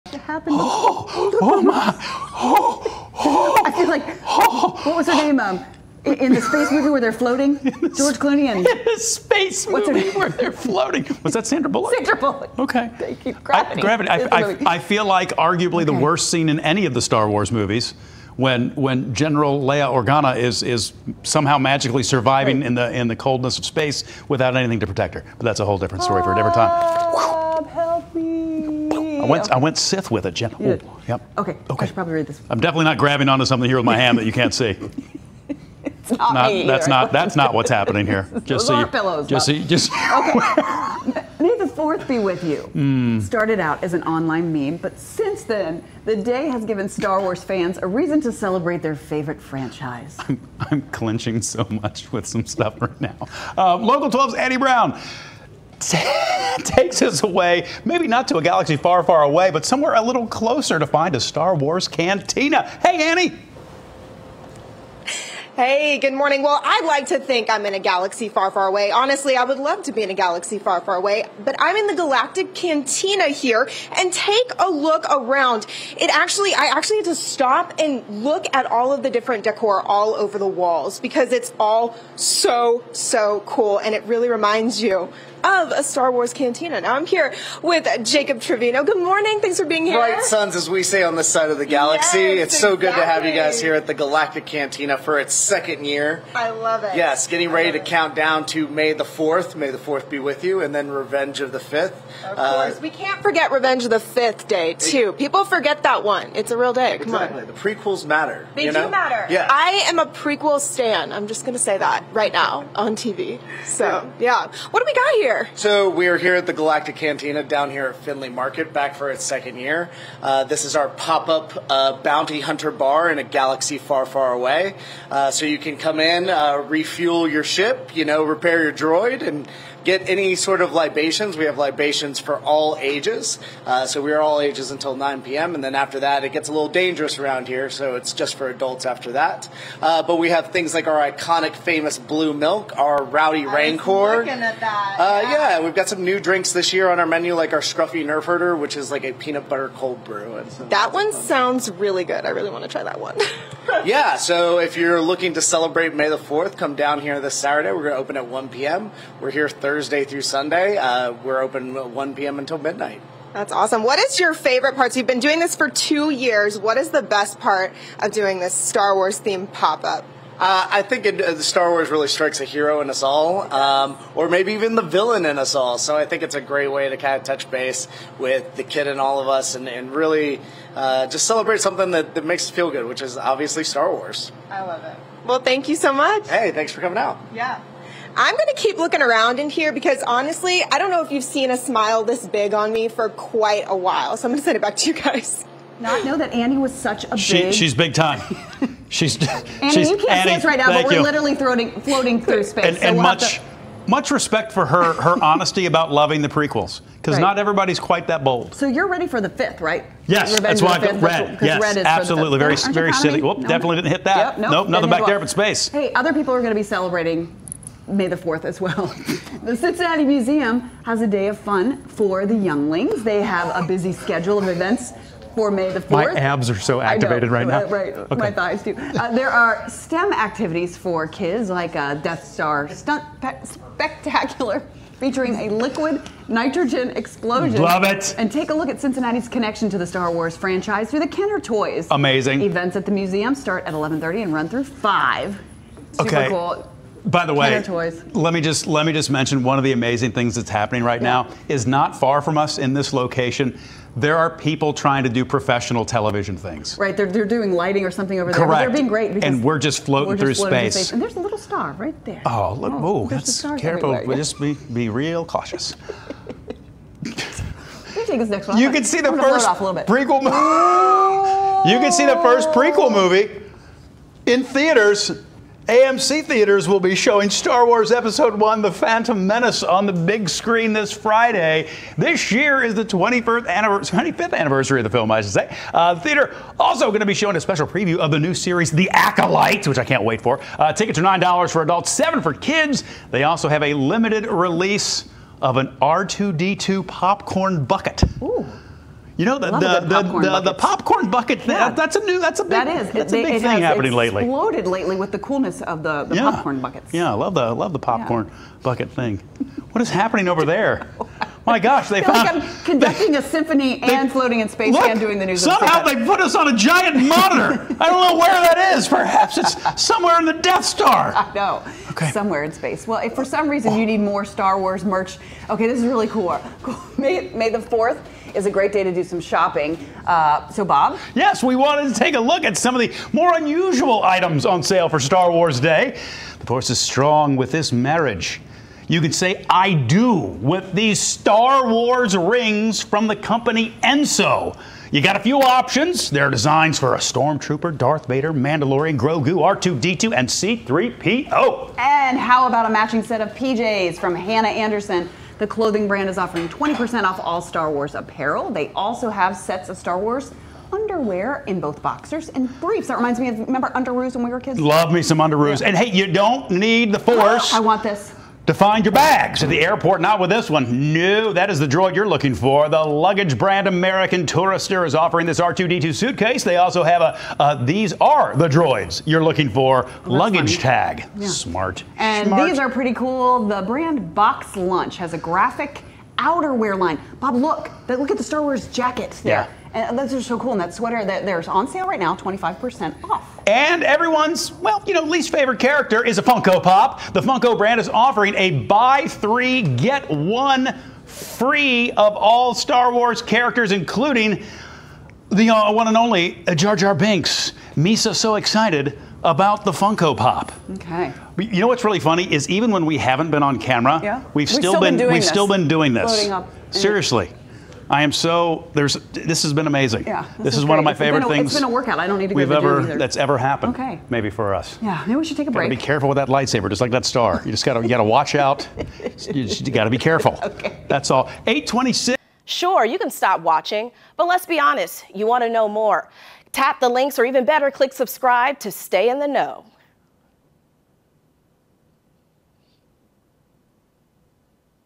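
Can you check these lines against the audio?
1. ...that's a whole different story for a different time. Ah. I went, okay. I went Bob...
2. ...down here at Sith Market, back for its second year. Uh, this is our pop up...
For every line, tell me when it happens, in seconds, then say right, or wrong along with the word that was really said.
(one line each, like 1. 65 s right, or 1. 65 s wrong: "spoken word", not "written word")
1. 25 s wrong: "Sith", not "Bob"
2. 117 s wrong: "Findlay", not "Sith".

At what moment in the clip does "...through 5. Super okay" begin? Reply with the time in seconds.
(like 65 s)
244 s.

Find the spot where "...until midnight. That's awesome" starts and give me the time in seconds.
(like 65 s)
162 s.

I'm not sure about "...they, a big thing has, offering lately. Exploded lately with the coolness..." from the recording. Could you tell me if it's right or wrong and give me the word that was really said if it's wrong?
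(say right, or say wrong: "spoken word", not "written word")
wrong: "happening", not "offering".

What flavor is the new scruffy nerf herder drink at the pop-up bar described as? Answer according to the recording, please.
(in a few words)
Peanut butter cold brew.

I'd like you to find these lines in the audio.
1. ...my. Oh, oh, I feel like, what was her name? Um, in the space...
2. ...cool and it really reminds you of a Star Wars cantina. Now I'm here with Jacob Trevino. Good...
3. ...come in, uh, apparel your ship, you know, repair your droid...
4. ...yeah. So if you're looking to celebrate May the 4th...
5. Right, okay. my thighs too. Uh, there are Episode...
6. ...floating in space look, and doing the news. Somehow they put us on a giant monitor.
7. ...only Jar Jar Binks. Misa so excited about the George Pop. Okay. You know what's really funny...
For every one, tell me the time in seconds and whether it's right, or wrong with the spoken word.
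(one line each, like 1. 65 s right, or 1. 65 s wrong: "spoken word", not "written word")
1. 1 s right
2. 83 s right
3. 125 s wrong: "refuel", not "apparel"
4. 153 s right
5. 227 s wrong: "STEM", not "Episode"
6. 314 s right
7. 405 s wrong: "Funko", not "George".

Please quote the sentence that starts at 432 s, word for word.
Sure, you can stop watching, but let's be honest.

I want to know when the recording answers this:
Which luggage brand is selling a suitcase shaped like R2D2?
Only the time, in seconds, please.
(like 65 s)
373 s.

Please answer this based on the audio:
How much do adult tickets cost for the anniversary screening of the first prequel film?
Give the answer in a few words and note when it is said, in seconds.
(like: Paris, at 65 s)
$9, at 291 s.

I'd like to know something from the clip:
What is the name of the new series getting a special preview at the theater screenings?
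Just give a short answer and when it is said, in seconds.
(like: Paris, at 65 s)
The Acolyte, at 288 s.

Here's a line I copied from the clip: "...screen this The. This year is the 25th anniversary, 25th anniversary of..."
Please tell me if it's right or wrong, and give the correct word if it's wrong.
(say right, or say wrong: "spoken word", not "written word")
wrong: "Friday", not "The".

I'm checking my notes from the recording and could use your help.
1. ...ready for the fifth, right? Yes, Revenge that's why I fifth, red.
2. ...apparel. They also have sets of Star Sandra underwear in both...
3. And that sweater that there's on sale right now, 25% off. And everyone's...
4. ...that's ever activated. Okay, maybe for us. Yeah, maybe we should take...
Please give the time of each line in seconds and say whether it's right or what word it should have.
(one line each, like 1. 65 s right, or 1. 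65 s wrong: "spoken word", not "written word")
1. 208 s right
2. 357 s wrong: "Wars", not "Sandra"
3. 390 s right
4. 422 s wrong: "happened", not "activated".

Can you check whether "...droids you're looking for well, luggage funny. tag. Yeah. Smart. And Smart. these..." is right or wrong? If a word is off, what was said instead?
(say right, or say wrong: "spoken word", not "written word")
right.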